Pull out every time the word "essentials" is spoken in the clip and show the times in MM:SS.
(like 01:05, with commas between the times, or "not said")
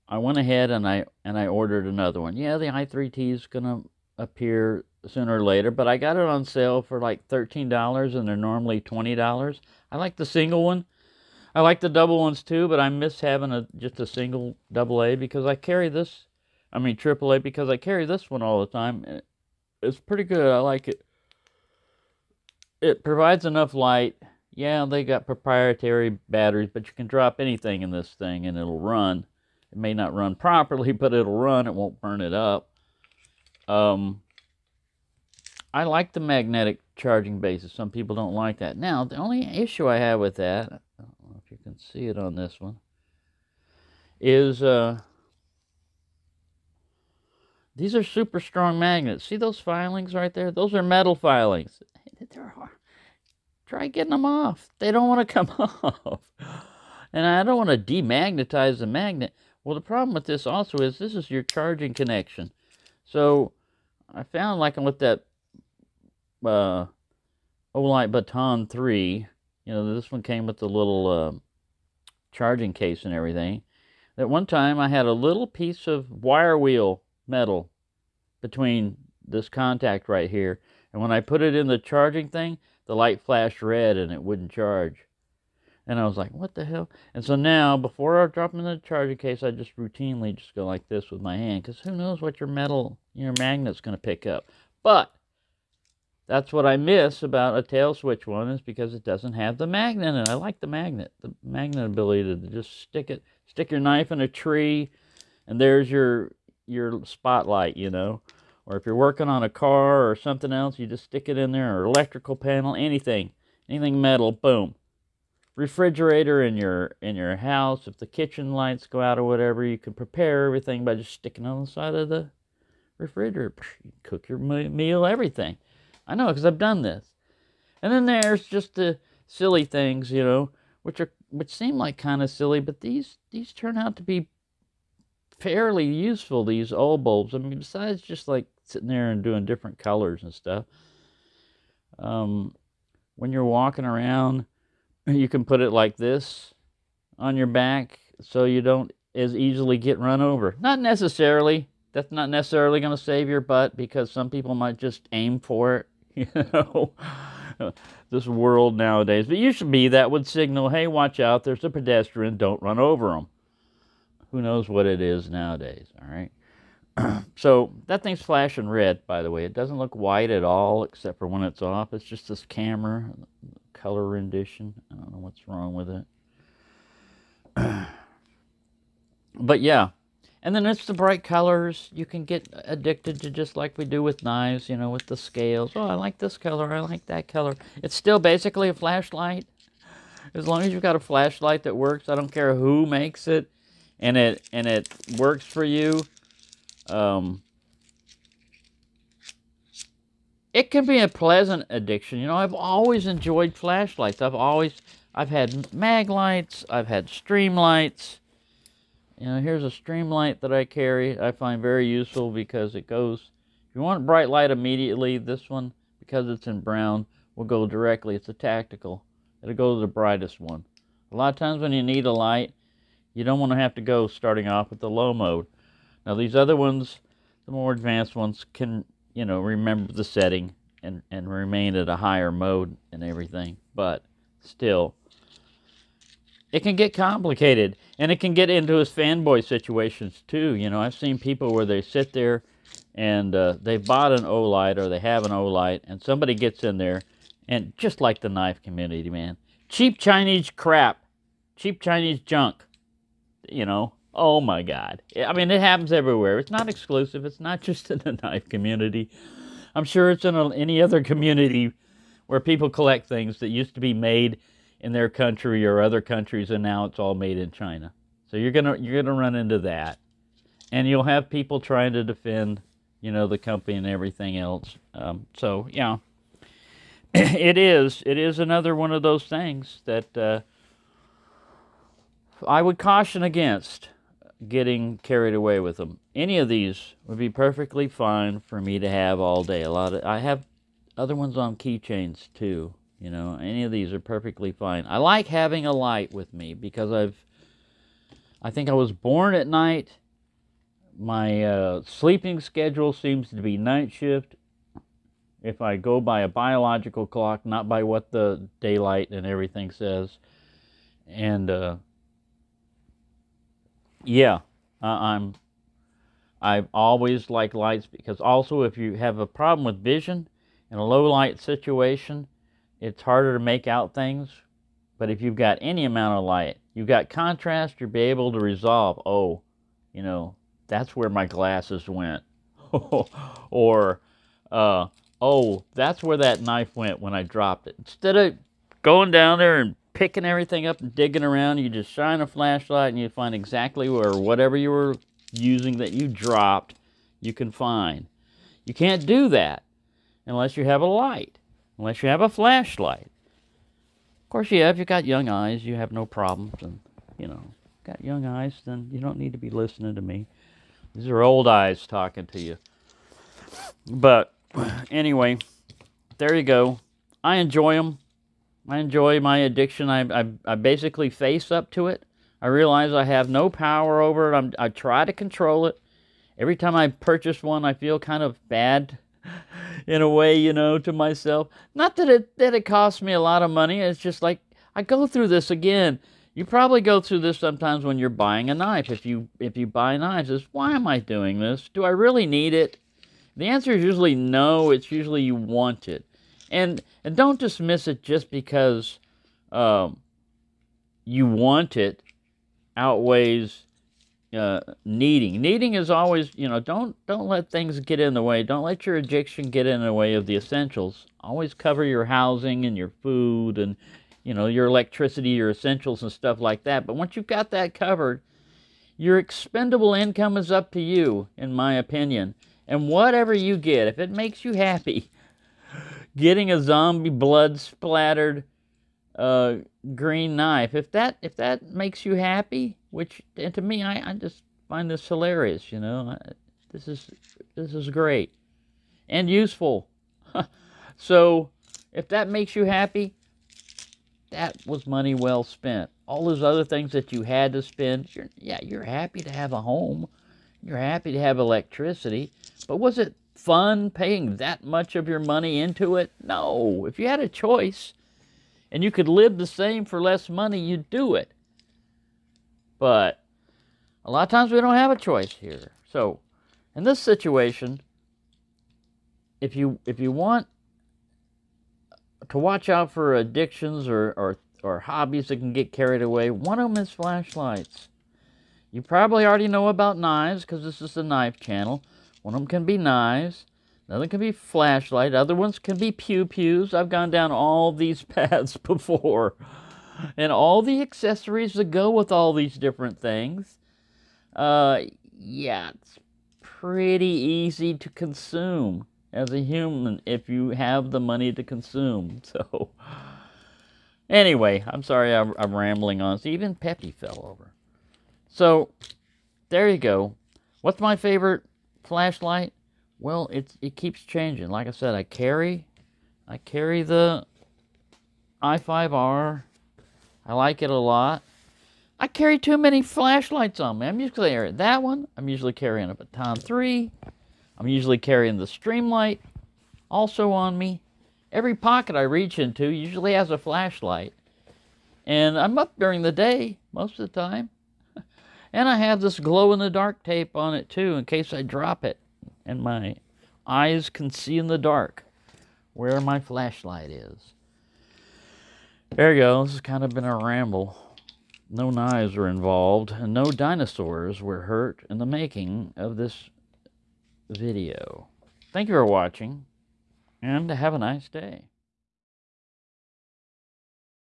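06:50, 06:55.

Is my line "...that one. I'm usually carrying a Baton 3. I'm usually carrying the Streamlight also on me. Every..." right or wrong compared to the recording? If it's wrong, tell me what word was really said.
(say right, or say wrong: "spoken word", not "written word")
right.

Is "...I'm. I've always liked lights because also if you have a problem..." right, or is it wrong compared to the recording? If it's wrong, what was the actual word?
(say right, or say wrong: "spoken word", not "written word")
right.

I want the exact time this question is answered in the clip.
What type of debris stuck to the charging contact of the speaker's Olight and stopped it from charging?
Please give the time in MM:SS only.
01:16.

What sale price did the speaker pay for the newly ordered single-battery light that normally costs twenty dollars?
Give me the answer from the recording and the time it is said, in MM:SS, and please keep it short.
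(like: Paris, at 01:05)
$13, at 00:07.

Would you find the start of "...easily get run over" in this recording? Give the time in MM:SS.
02:29.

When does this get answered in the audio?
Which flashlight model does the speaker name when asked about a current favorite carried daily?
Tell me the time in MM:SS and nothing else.
08:38.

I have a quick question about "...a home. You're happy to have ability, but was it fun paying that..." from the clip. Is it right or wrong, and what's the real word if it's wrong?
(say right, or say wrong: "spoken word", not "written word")
wrong: "electricity", not "ability".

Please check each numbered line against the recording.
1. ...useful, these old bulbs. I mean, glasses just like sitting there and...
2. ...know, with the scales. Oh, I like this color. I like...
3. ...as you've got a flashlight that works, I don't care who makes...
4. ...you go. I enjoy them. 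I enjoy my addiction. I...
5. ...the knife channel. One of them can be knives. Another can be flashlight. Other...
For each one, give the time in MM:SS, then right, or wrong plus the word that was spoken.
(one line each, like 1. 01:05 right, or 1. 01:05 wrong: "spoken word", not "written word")
1. 02:15 wrong: "besides", not "glasses"
2. 03:04 right
3. 03:10 right
4. 06:06 right
5. 08:00 right.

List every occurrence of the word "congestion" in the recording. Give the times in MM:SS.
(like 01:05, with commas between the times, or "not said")
not said.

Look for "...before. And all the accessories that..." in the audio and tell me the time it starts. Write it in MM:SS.
08:08.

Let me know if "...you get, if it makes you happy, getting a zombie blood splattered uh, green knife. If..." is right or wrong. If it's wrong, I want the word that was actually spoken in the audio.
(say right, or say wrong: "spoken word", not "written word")
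right.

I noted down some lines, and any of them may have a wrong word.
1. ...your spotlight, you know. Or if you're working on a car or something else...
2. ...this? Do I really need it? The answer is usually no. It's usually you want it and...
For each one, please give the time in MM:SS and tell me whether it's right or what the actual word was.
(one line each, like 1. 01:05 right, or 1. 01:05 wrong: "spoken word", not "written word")
1. 01:46 right
2. 06:31 right.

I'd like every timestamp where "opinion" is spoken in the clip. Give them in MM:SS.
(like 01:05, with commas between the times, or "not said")
07:01.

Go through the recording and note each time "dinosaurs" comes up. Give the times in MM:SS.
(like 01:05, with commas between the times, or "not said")
09:13.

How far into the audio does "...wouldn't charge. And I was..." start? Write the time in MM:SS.
01:24.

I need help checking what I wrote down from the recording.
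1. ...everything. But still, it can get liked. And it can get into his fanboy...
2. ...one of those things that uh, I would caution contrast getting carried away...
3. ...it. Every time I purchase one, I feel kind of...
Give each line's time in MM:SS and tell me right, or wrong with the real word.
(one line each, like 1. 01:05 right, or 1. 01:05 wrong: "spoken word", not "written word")
1. 03:53 wrong: "complicated", not "liked"
2. 04:38 wrong: "against", not "contrast"
3. 06:15 right.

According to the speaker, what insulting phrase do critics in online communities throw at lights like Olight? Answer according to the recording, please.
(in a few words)
Cheap Chinese crap.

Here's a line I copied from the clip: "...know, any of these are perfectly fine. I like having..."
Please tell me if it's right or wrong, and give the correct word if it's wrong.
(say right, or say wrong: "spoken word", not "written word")
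right.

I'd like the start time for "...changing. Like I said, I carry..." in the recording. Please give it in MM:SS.
08:34.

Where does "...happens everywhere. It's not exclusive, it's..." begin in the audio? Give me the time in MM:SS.
04:15.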